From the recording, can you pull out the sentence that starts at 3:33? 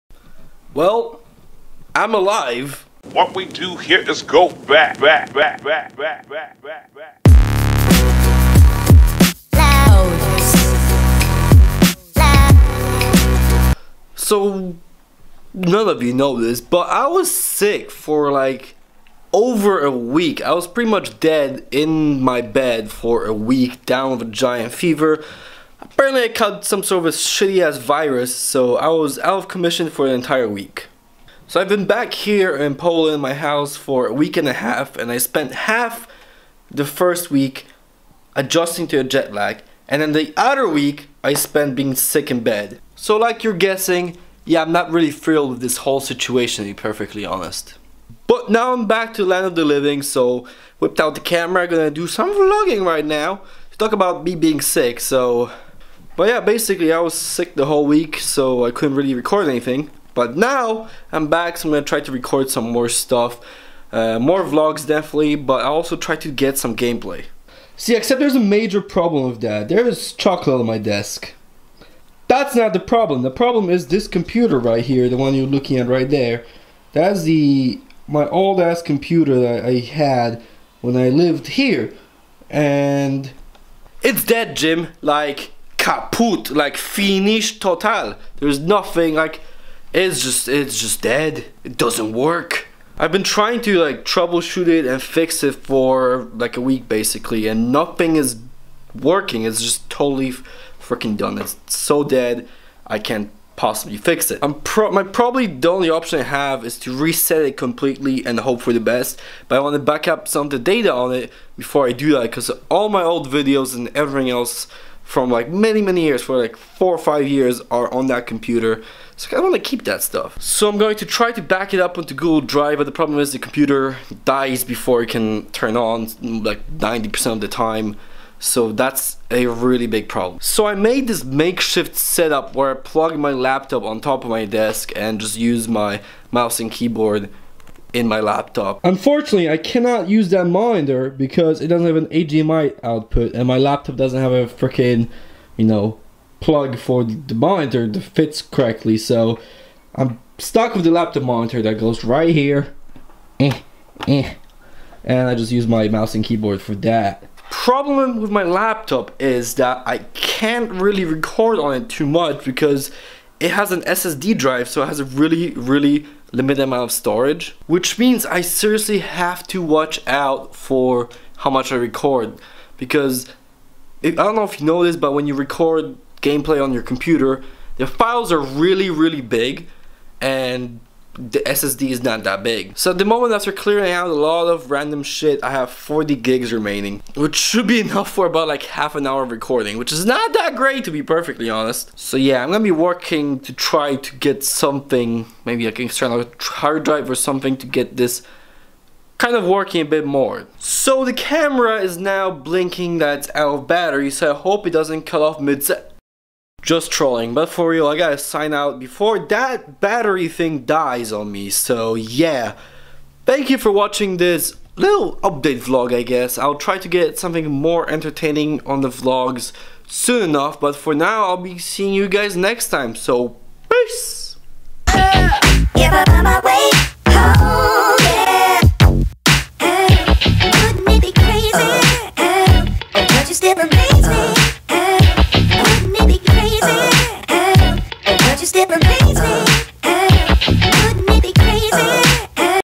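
Thank you for watching this little update vlog, I guess.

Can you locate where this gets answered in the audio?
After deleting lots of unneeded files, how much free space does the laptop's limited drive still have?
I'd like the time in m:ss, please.
3:05.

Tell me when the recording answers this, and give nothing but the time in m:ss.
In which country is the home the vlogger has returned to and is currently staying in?
0:32.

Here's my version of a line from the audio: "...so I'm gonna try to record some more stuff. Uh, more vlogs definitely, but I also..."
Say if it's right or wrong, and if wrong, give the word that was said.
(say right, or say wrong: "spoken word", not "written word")
right.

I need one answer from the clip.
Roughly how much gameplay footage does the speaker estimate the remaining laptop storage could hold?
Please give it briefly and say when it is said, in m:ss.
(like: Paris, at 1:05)
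half an hour, at 3:08.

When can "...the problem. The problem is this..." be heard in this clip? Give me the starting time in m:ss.
1:12.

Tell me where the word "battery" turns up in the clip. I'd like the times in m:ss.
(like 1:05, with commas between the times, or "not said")
3:23, 3:29.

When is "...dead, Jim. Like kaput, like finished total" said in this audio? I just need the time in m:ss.
1:24.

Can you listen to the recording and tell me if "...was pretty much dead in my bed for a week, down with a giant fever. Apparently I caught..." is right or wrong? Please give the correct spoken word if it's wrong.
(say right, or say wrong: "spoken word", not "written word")
right.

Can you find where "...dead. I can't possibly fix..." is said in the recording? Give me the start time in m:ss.
1:42.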